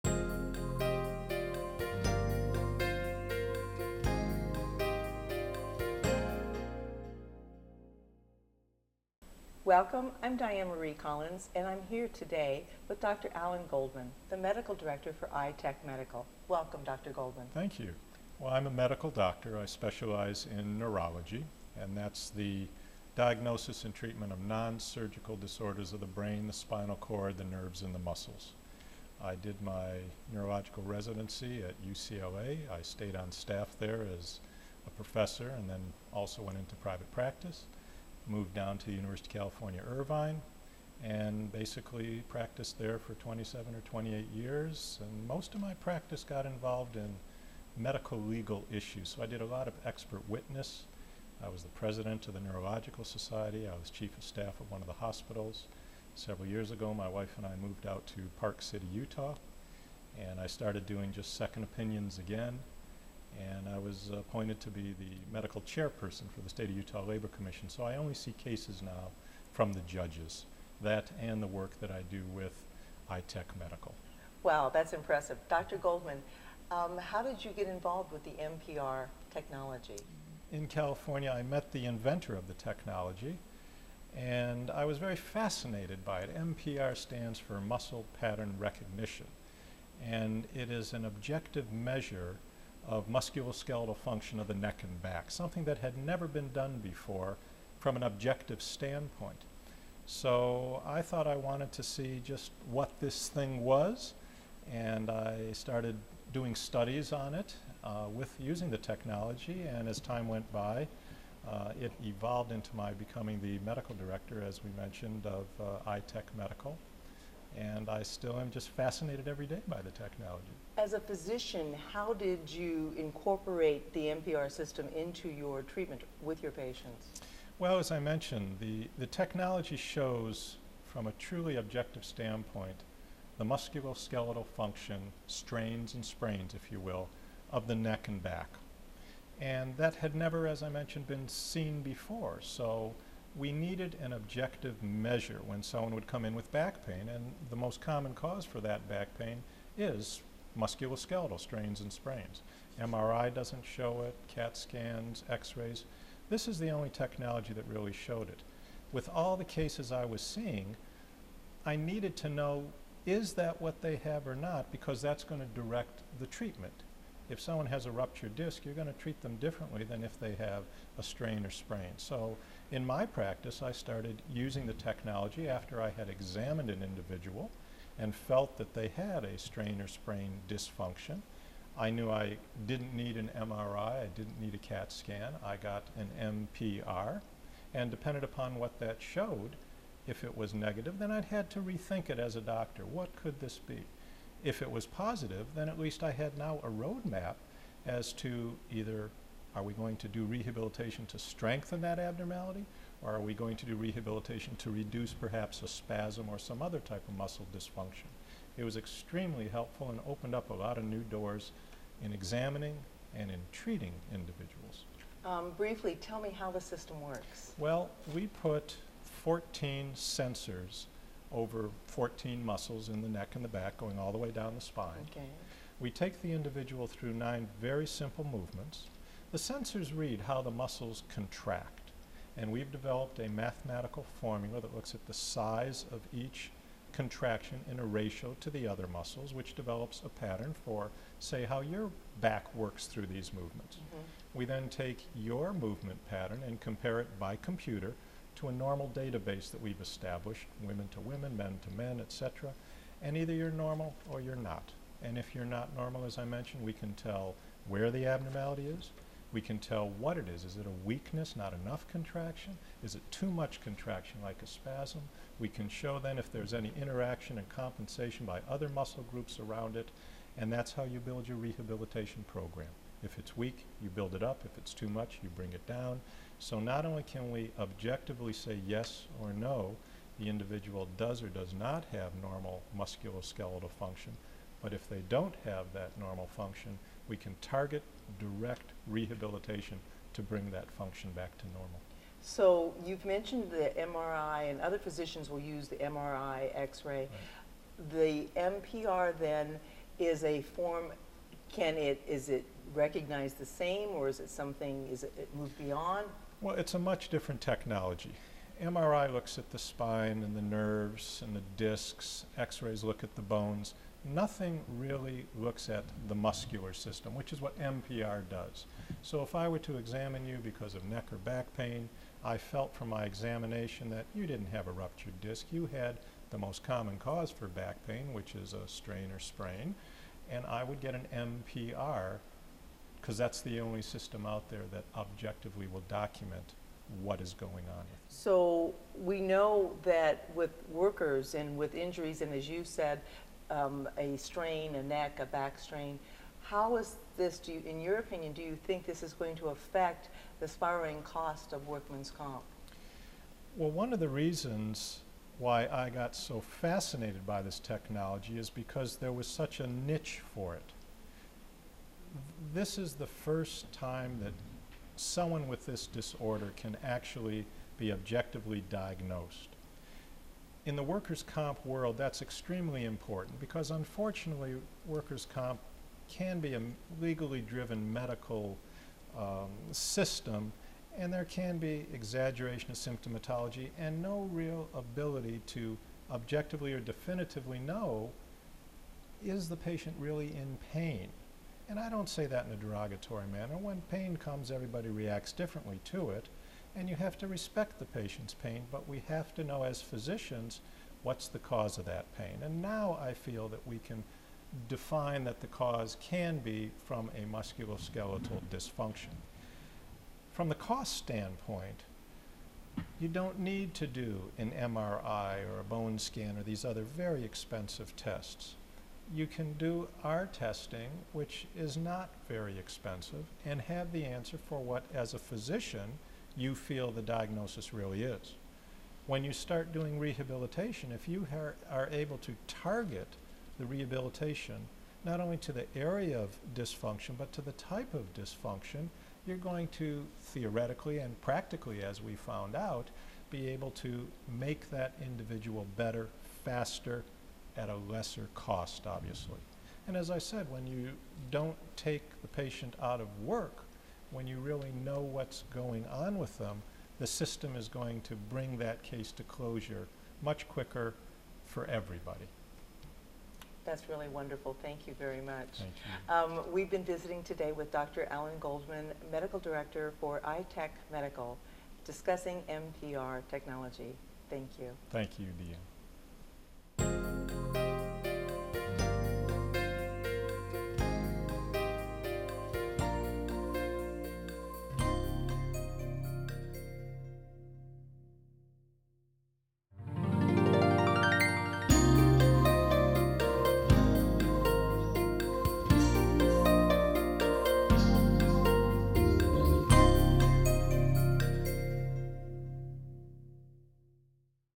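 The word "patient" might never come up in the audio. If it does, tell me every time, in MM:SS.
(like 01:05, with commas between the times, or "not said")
02:06, 06:29, 06:37, 07:32.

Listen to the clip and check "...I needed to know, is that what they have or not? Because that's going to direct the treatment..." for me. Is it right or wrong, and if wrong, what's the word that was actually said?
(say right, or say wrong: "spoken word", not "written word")
right.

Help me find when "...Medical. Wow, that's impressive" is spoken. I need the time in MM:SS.
01:13.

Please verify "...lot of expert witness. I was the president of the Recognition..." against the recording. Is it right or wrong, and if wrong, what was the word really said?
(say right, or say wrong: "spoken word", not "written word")
wrong: "Neurological", not "Recognition".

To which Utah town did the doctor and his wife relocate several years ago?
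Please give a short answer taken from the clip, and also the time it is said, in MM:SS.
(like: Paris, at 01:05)
Park City, at 00:58.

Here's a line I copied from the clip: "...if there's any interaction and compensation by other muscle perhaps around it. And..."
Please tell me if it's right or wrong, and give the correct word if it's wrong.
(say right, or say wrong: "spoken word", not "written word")
wrong: "groups", not "perhaps".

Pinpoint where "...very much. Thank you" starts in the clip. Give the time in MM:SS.
07:44.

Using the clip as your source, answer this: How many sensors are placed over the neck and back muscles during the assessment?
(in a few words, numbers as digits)
14.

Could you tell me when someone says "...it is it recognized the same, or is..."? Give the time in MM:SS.
05:01.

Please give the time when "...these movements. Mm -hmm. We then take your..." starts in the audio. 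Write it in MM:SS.
04:03.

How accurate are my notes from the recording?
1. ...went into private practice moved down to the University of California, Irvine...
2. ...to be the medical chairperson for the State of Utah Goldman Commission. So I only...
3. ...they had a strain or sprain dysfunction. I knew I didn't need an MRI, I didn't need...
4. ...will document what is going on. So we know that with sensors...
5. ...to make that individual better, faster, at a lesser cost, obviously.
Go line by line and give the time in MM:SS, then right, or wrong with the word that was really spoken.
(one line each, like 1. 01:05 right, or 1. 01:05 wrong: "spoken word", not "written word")
1. 00:36 right
2. 01:04 wrong: "Labor", not "Goldman"
3. 02:58 right
4. 05:35 wrong: "workers", not "sensors"
5. 07:23 right.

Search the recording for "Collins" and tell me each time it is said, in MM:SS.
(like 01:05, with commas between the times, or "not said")
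00:10.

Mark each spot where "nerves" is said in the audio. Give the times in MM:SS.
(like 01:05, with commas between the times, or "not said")
00:27, 05:10.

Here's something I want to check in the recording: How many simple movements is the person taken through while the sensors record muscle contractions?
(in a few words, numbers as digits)
9.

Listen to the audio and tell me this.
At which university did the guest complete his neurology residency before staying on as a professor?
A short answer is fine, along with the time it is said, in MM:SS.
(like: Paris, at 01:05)
UCLA, at 00:31.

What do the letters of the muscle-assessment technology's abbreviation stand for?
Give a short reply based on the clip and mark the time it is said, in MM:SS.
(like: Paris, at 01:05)
Muscle Pattern Recognition, at 01:27.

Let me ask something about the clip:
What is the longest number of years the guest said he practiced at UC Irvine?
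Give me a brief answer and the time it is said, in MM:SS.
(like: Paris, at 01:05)
28, at 00:43.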